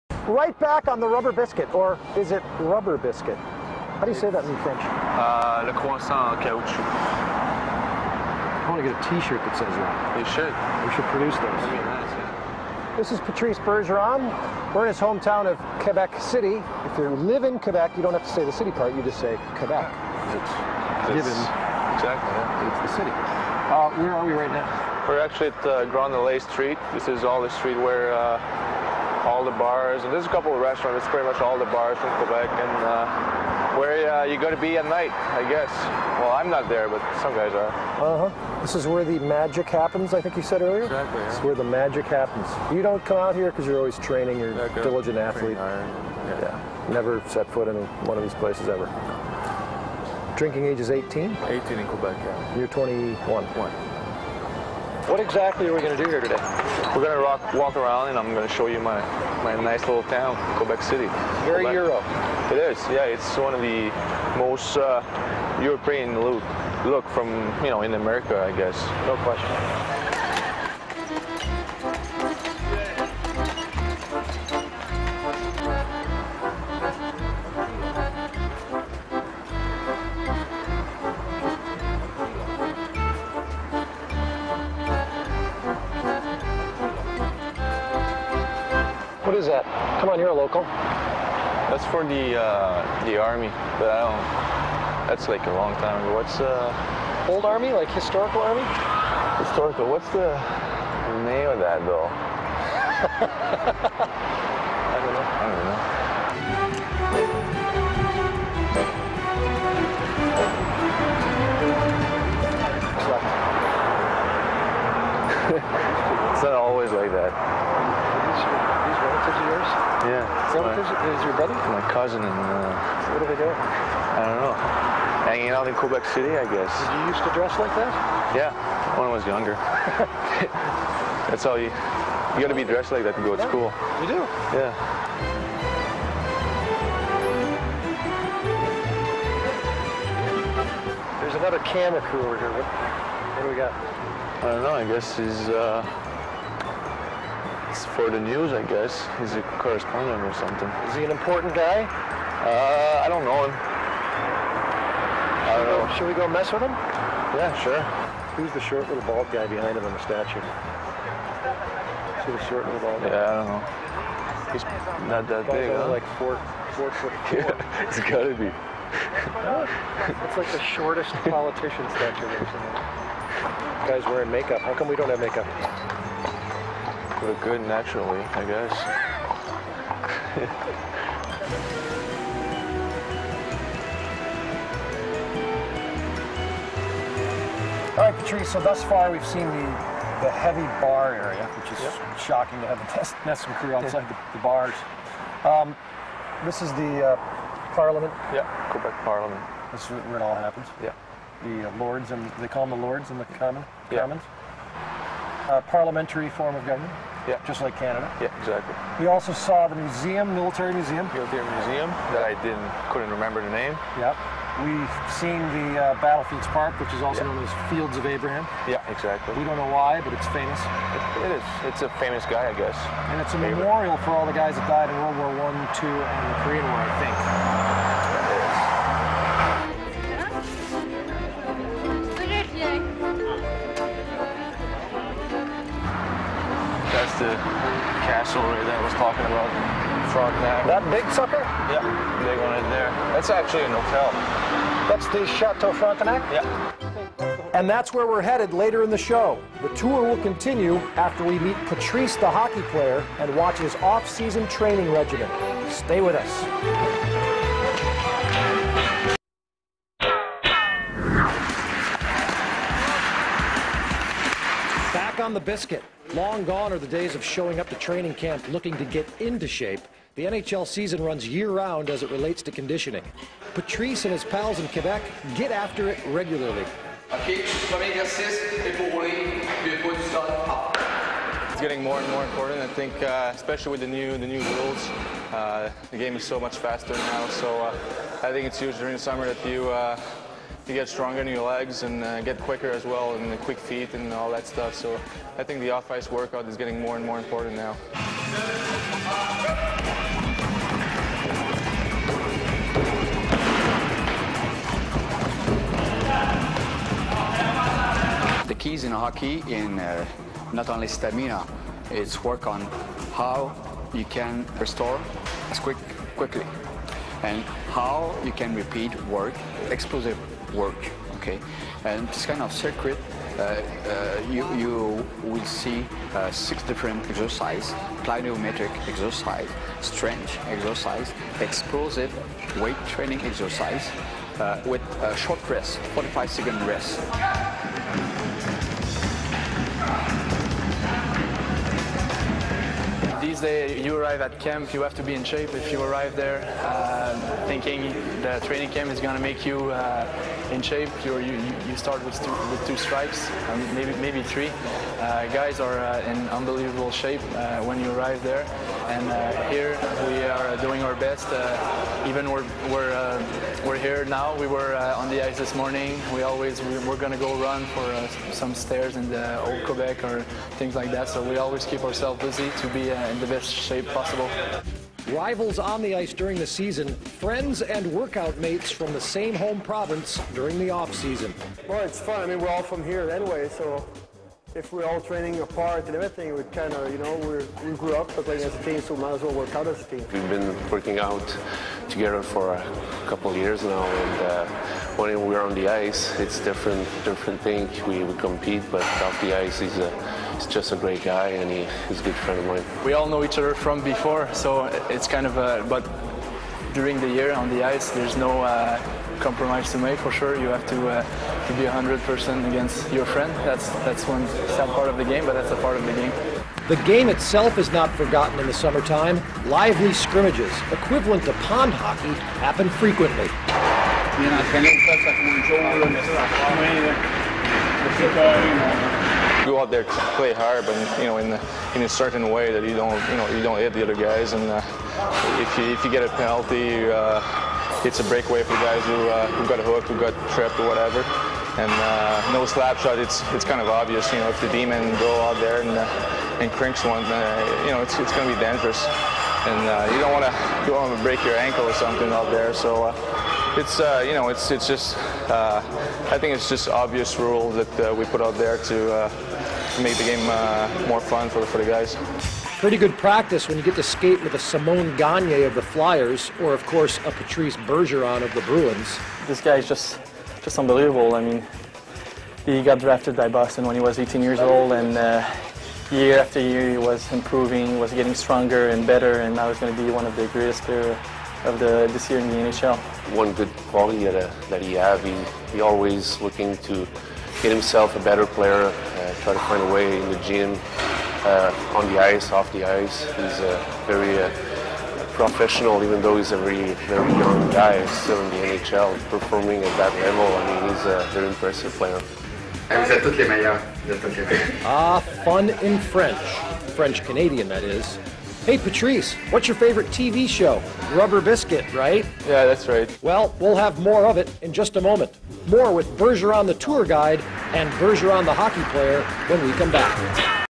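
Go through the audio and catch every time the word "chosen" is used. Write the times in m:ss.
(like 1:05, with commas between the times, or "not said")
not said.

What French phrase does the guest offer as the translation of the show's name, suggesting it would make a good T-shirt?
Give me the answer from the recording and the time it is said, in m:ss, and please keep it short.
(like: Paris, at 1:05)
le croissant en caoutchouc, at 0:05.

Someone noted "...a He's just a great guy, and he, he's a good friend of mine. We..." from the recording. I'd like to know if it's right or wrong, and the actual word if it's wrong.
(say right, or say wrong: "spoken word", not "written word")
right.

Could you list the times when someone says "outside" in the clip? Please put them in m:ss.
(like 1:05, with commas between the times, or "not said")
3:13.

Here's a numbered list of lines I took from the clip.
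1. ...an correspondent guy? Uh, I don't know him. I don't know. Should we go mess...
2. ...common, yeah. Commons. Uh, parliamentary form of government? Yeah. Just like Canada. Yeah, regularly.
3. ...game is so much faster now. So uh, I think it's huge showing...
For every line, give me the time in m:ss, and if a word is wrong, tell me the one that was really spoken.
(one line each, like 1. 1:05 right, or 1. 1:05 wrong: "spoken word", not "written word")
1. 2:31 wrong: "important", not "correspondent"
2. 3:23 wrong: "exactly", not "regularly"
3. 4:45 wrong: "during", not "showing".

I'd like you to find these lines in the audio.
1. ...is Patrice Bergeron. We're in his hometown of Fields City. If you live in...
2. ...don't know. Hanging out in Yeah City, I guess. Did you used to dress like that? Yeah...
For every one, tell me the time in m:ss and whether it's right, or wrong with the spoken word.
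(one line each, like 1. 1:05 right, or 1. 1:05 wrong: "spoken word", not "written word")
1. 0:13 wrong: "Quebec", not "Fields"
2. 2:04 wrong: "Quebec", not "Yeah".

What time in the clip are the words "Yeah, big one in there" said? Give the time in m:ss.
4:01.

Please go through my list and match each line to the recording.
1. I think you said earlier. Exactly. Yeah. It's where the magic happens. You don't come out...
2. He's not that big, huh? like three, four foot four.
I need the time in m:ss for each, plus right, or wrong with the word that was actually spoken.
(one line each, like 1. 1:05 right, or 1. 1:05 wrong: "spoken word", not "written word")
1. 0:40 right
2. 2:44 wrong: "four", not "three".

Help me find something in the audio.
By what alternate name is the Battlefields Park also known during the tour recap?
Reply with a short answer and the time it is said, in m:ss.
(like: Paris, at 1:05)
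Fields of Abraham, at 3:37.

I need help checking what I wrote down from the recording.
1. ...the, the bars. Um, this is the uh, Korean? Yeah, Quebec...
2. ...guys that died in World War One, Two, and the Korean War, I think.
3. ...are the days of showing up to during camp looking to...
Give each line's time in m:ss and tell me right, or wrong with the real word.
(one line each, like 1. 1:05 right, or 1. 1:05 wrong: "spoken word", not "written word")
1. 3:14 wrong: "Parliament", not "Korean"
2. 3:44 right
3. 4:26 wrong: "training", not "during".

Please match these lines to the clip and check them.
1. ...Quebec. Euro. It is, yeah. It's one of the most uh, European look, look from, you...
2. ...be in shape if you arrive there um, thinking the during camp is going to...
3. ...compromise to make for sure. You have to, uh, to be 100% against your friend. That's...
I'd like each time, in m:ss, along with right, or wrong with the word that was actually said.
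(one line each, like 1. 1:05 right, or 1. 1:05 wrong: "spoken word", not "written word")
1. 1:01 right
2. 5:45 wrong: "training", not "during"
3. 6:49 right.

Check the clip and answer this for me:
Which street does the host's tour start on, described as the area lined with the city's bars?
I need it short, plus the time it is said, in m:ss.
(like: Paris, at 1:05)
Grand Allée, at 0:25.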